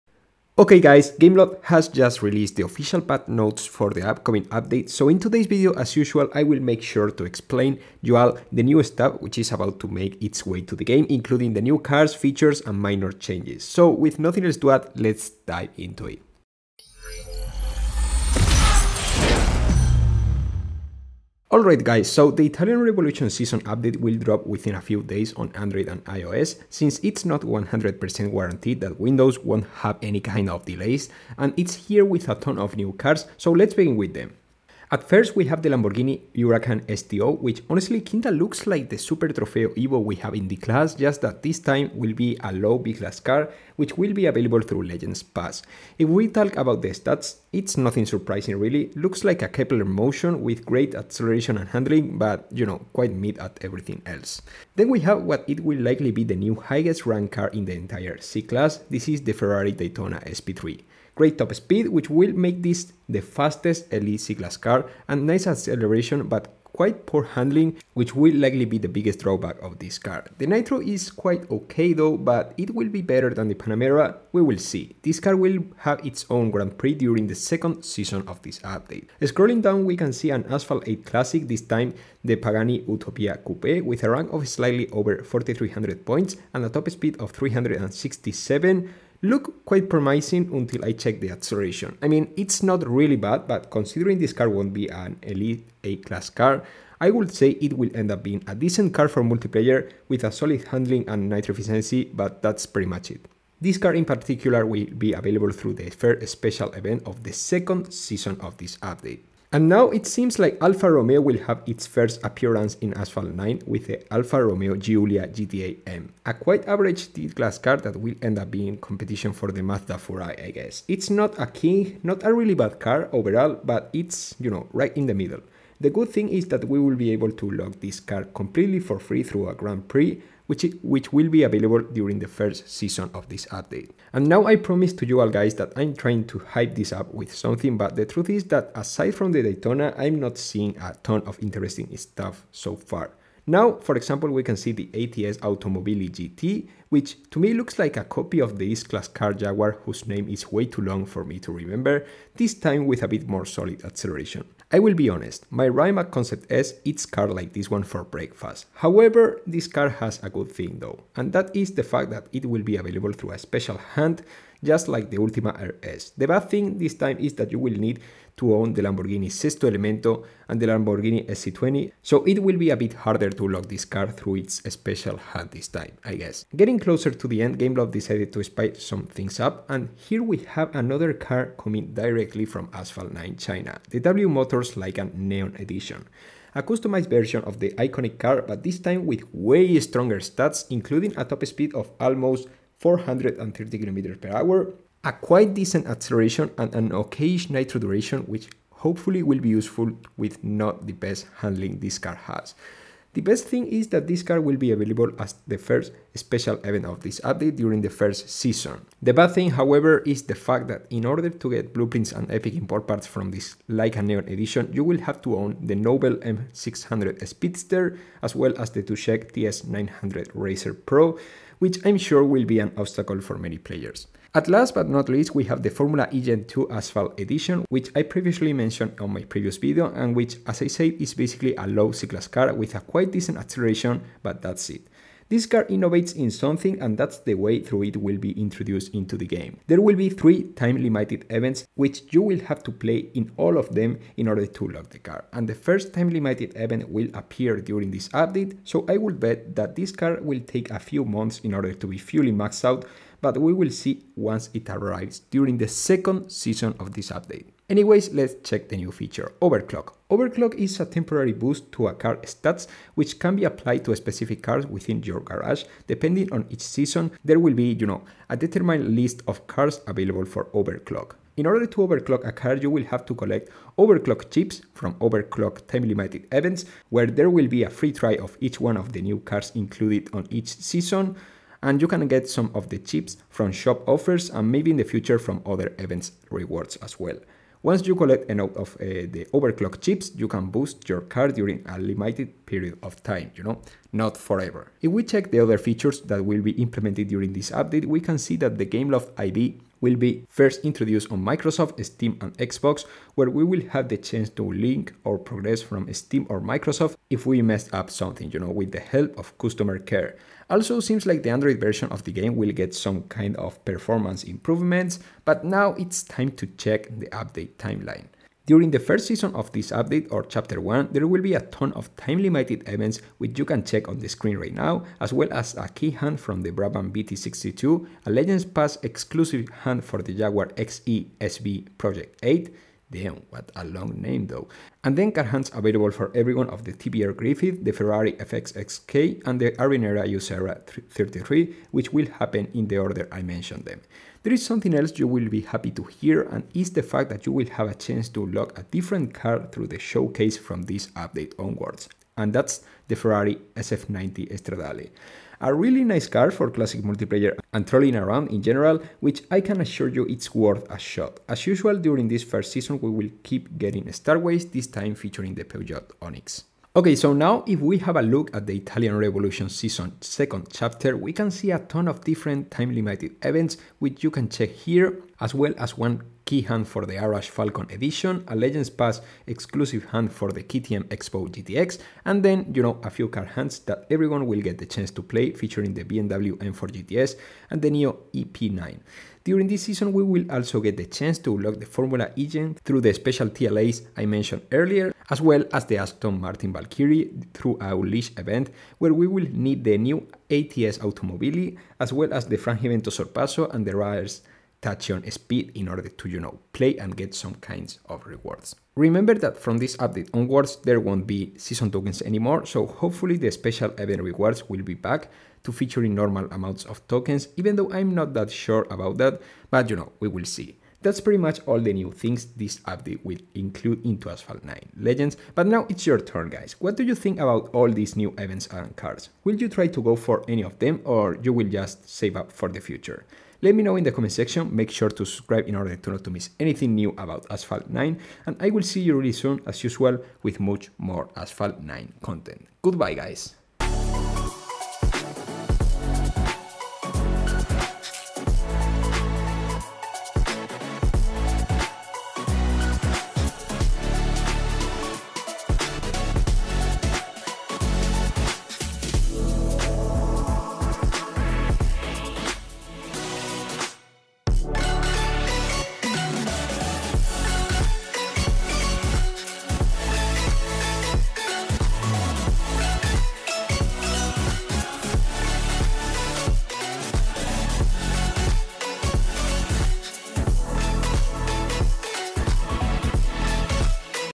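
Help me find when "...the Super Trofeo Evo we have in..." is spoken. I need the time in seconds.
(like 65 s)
38 s.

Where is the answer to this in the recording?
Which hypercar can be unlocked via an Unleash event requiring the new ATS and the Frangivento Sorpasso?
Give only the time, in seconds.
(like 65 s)
395 s.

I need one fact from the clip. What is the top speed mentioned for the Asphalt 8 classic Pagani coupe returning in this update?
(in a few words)
367.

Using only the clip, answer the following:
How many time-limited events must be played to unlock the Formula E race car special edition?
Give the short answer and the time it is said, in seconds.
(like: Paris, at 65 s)
3, at 240 s.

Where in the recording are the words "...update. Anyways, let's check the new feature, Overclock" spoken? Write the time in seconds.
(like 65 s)
257 s.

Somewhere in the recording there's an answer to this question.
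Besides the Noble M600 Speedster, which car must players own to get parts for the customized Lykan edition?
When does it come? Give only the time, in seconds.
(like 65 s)
218 s.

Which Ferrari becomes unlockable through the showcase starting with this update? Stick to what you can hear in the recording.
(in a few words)
Ferrari SF90 Stradale.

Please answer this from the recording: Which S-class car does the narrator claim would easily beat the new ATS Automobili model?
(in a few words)
Rimac Concept S.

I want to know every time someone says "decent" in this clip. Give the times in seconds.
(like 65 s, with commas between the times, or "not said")
98 s, 195 s, 233 s.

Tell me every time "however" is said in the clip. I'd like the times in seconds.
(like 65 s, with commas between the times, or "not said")
158 s, 209 s.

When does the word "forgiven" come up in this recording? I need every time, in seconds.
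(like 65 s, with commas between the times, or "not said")
not said.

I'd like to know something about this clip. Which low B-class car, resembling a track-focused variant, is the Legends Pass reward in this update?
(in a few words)
Lamborghini Huracan STO.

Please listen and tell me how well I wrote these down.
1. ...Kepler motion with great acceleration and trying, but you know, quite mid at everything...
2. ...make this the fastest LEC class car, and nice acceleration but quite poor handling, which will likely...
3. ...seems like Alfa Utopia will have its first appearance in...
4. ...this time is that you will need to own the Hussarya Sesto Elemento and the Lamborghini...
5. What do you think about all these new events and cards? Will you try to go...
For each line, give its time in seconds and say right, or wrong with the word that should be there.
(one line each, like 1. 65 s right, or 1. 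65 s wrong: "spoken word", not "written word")
1. 49 s wrong: "handling", not "trying"
2. 62 s right
3. 110 s wrong: "Romeo", not "Utopia"
4. 166 s wrong: "Lamborghini", not "Hussarya"
5. 426 s right.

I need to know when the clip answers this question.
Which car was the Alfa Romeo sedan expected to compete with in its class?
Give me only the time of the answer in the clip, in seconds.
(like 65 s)
119 s.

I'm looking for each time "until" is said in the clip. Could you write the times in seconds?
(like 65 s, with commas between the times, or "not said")
90 s.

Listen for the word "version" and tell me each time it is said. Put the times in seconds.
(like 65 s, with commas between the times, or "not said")
187 s, 311 s.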